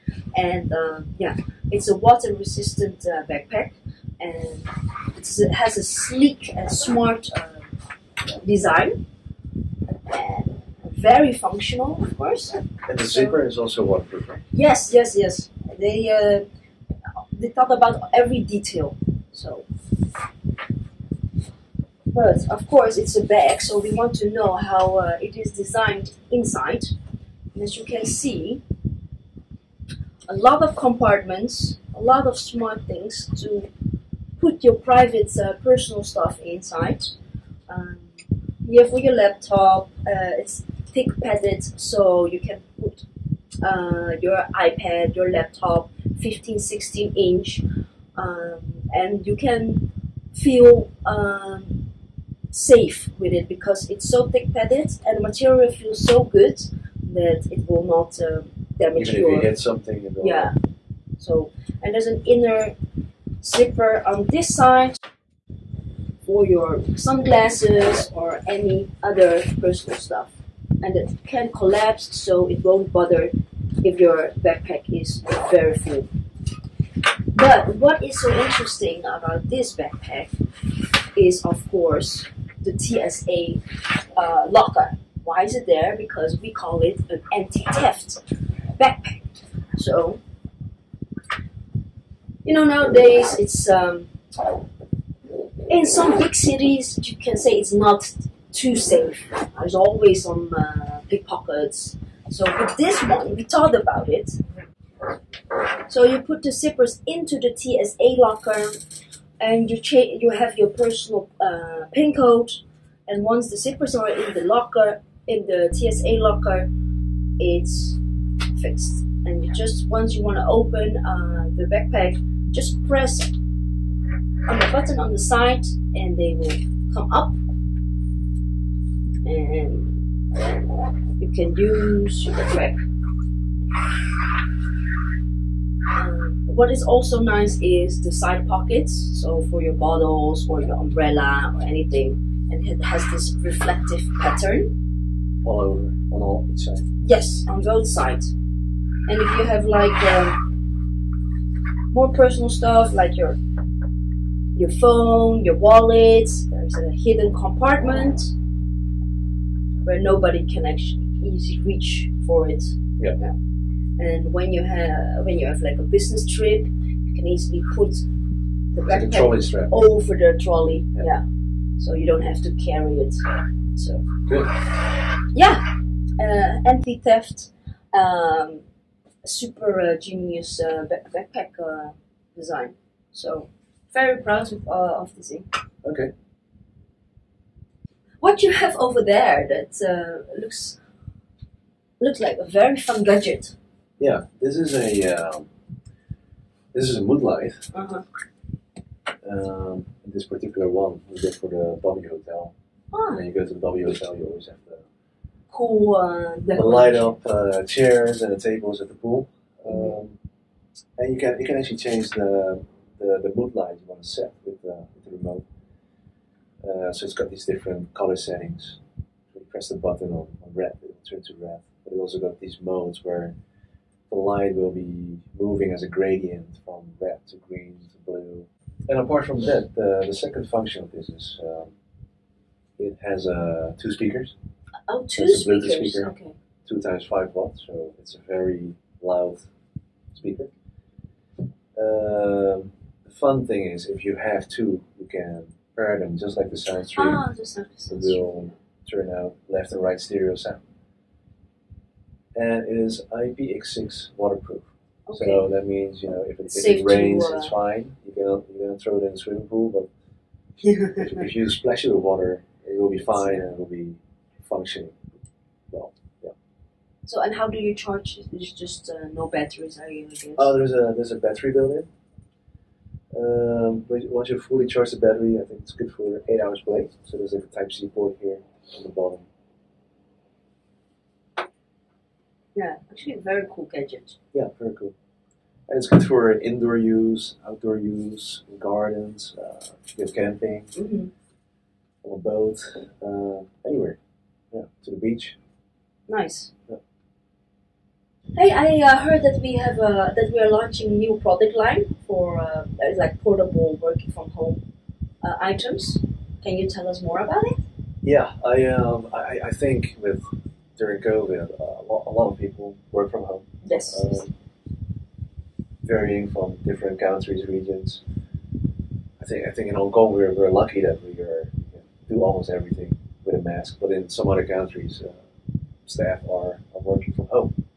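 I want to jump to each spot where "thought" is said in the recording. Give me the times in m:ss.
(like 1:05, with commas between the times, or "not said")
0:17, 1:43.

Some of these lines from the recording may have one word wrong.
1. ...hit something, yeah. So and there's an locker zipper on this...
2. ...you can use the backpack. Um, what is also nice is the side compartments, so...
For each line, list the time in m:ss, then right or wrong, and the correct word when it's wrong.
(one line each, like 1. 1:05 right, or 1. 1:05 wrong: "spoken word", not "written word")
1. 0:59 wrong: "inner", not "locker"
2. 2:11 wrong: "pockets", not "compartments".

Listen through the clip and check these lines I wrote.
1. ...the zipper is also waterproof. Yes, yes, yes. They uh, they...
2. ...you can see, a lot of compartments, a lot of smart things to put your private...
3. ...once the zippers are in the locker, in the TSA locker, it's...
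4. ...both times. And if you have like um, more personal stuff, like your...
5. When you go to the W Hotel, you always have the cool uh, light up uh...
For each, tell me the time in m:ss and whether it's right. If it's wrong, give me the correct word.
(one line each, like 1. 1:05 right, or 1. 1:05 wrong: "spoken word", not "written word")
1. 0:12 right
2. 0:27 right
3. 1:53 right
4. 2:27 wrong: "sides", not "times"
5. 3:23 right.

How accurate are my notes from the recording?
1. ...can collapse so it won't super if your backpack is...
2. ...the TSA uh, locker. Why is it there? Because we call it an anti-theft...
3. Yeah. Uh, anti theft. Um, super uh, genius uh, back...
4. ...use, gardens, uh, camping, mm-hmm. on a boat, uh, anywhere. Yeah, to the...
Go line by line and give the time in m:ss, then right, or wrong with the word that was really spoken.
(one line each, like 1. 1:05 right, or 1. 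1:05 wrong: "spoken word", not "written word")
1. 1:11 wrong: "bother", not "super"
2. 1:22 right
3. 2:55 right
4. 4:47 right.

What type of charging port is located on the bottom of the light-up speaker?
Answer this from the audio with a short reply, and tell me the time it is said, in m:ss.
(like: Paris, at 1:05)
Type C, at 4:37.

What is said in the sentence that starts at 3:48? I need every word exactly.
And apart from that, the, the second function of this is um, it has uh, two speakers.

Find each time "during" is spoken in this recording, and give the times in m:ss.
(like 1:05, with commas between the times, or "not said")
5:10.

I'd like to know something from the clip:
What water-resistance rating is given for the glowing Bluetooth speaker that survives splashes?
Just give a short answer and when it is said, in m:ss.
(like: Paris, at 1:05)
IPX6, at 4:13.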